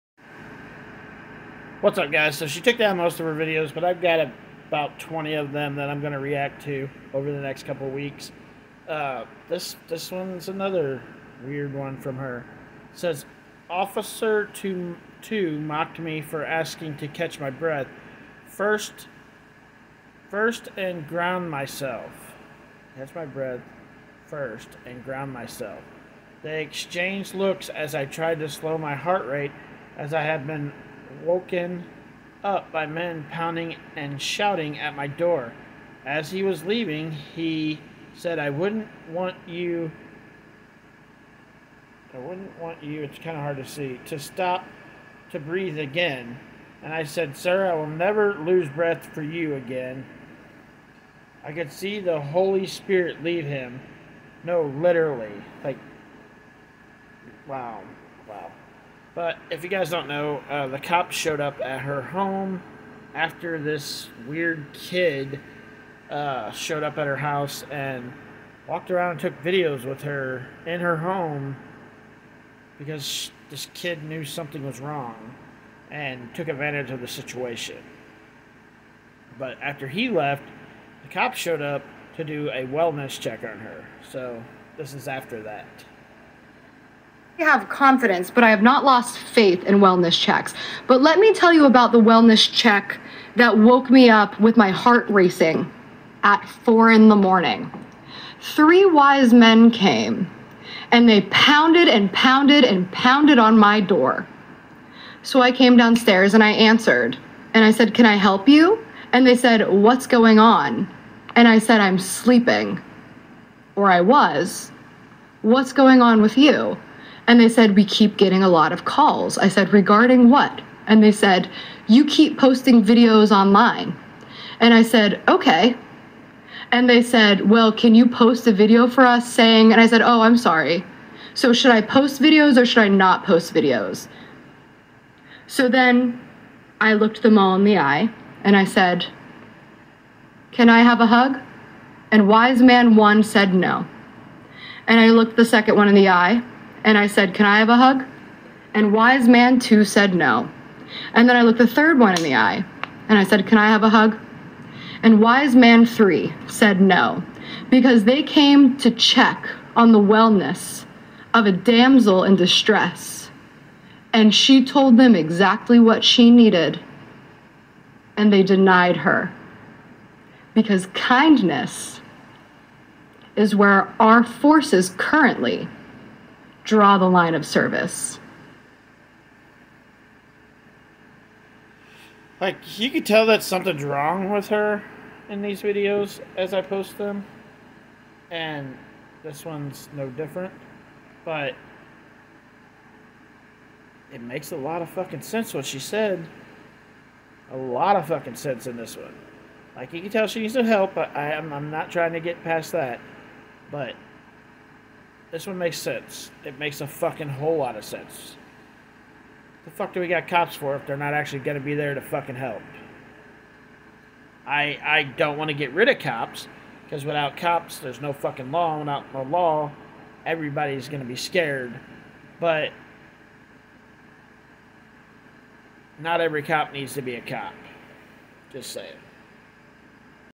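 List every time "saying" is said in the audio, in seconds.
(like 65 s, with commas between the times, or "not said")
129 s, 228 s.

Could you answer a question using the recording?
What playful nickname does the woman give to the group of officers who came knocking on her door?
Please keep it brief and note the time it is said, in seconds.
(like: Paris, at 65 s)
Three wise men, at 98 s.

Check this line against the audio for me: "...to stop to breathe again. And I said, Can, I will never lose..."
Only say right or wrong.
wrong.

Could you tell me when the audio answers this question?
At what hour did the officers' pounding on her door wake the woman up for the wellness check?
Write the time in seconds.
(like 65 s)
96 s.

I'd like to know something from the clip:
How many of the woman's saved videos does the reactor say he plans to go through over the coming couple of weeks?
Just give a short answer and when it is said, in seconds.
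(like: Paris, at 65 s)
20, at 4 s.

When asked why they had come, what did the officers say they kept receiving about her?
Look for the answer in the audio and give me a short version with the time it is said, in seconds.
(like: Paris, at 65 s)
a lot of calls, at 118 s.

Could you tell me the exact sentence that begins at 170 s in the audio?
Because kindness is where our forces currently draw the line of service.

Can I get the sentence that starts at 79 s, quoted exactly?
But after he left, the cops showed up to do a wellness check on her.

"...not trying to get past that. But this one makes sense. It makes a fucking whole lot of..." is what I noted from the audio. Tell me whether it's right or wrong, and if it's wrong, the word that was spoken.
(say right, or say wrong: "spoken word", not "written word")
right.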